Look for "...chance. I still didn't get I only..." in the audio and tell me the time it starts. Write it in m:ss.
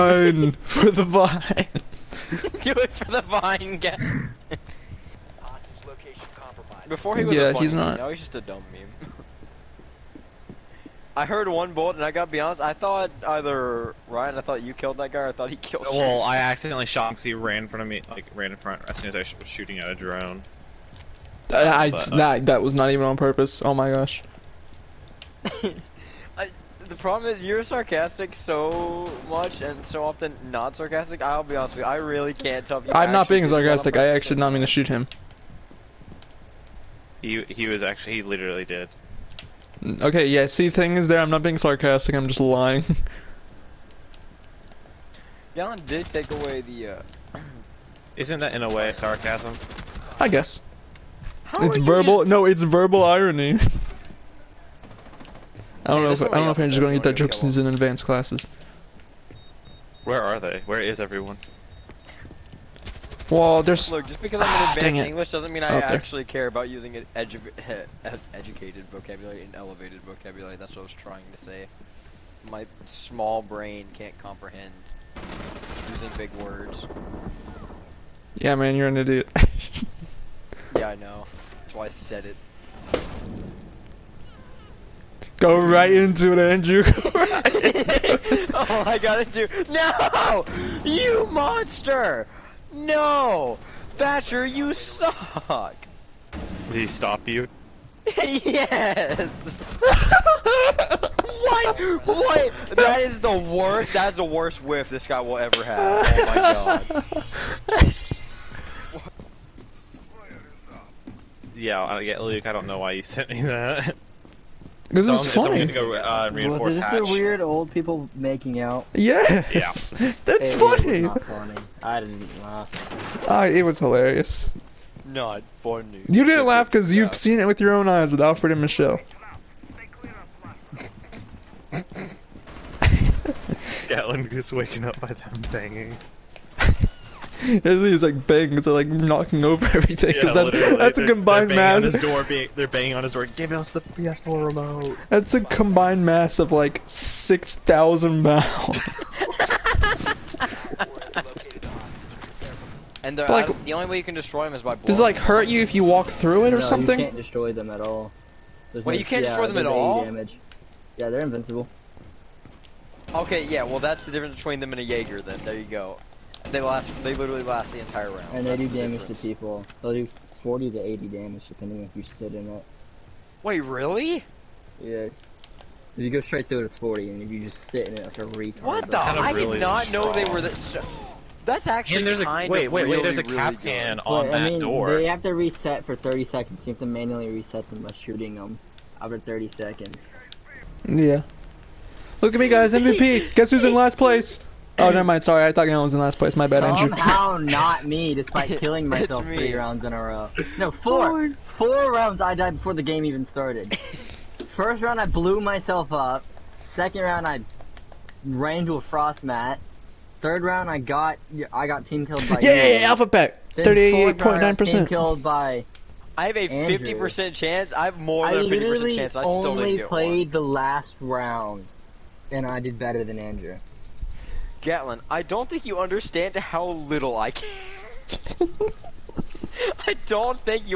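3:38.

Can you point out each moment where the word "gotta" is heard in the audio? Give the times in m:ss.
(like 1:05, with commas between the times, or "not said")
0:12.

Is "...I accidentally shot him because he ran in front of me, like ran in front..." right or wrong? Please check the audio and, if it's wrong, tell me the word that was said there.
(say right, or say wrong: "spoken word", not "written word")
right.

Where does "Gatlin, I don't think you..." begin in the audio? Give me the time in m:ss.
3:44.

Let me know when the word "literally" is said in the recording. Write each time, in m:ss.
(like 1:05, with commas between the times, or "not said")
0:38, 2:47.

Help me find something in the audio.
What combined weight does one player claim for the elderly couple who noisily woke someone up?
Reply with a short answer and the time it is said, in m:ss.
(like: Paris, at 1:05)
6,000 pounds, at 2:26.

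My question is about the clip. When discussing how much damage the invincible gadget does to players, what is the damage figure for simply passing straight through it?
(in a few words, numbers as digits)
40.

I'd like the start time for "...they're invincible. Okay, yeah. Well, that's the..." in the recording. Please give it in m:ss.
2:41.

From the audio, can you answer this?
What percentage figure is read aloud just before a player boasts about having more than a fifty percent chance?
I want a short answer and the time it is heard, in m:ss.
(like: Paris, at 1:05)
38.9%, at 3:33.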